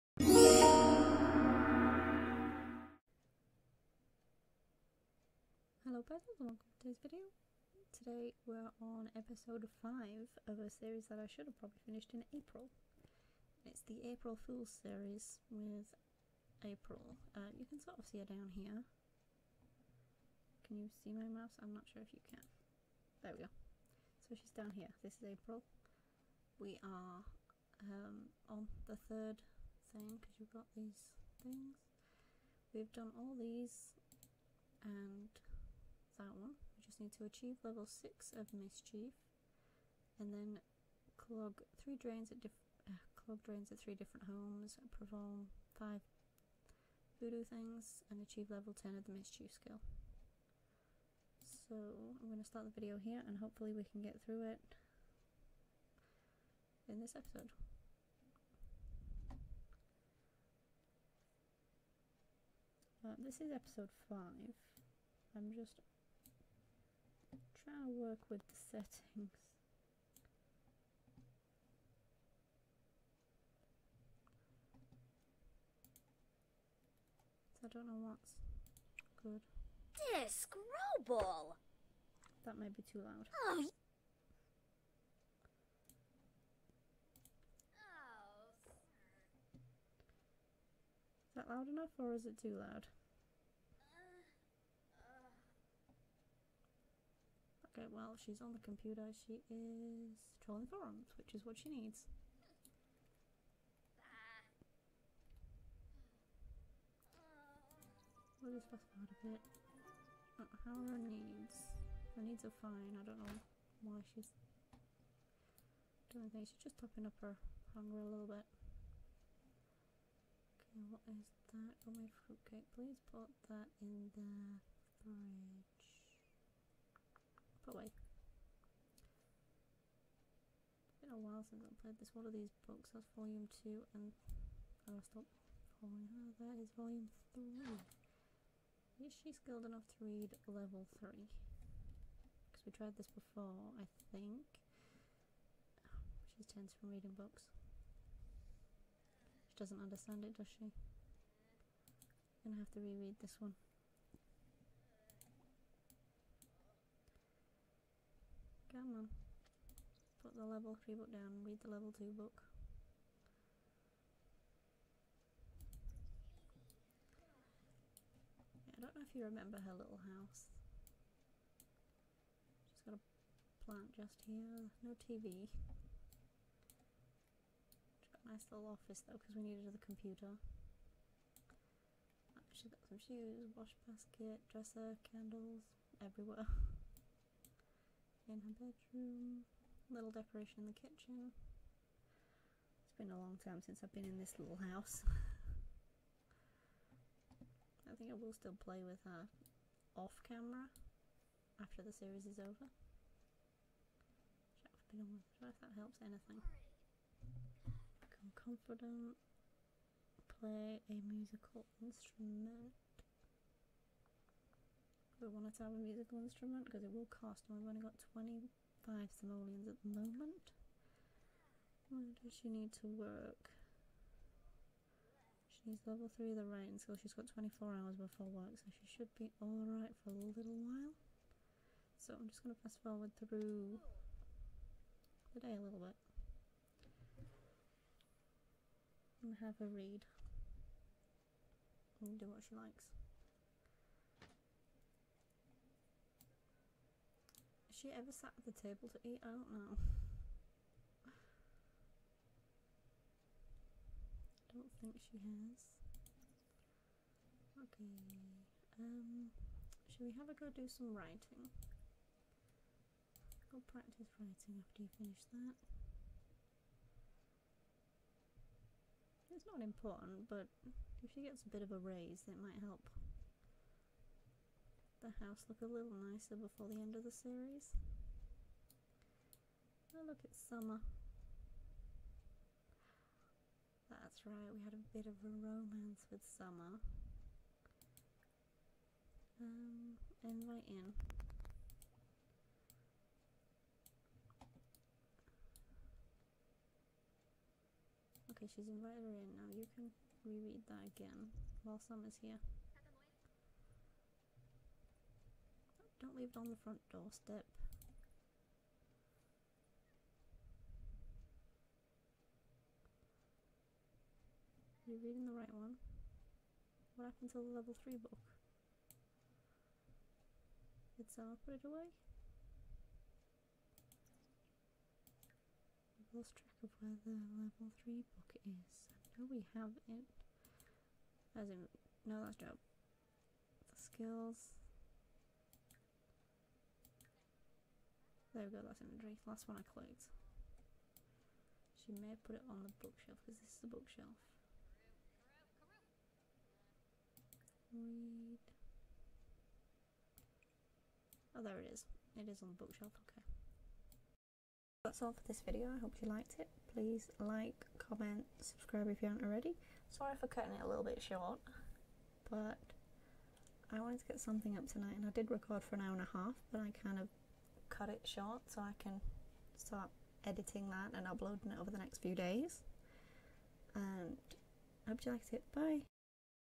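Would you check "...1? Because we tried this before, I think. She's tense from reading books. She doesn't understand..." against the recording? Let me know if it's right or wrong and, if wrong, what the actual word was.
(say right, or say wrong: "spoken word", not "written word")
wrong: "3", not "1".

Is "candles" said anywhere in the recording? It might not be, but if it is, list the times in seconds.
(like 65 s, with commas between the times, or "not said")
185 s.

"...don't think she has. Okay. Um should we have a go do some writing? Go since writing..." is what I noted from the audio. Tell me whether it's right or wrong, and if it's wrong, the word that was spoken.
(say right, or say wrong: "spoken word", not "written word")
wrong: "practice", not "since".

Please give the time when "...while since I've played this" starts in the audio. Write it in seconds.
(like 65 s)
131 s.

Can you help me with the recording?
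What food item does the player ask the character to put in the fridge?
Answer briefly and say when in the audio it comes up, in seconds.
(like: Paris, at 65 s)
fruitcake, at 122 s.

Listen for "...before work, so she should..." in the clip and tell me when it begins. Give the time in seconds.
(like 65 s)
228 s.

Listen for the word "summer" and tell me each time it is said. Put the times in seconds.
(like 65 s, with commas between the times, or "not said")
280 s, 286 s, 301 s.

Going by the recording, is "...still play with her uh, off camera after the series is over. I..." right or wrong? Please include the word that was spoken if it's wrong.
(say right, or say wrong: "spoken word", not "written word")
right.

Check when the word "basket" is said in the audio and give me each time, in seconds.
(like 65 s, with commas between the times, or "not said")
183 s.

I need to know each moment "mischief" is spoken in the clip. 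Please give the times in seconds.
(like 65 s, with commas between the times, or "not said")
38 s, 49 s.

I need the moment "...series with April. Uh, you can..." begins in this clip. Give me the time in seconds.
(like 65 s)
14 s.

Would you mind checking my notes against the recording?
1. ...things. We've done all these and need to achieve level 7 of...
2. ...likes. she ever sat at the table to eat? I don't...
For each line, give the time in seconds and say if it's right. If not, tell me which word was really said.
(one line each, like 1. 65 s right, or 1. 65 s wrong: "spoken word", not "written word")
1. 31 s wrong: "6", not "7"
2. 242 s right.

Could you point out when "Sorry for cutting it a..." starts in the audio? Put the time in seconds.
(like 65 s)
359 s.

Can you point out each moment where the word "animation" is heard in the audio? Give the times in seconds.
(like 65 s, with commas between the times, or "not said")
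not said.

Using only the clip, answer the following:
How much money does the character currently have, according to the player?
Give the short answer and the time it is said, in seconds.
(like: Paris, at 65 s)
25 simoleons, at 218 s.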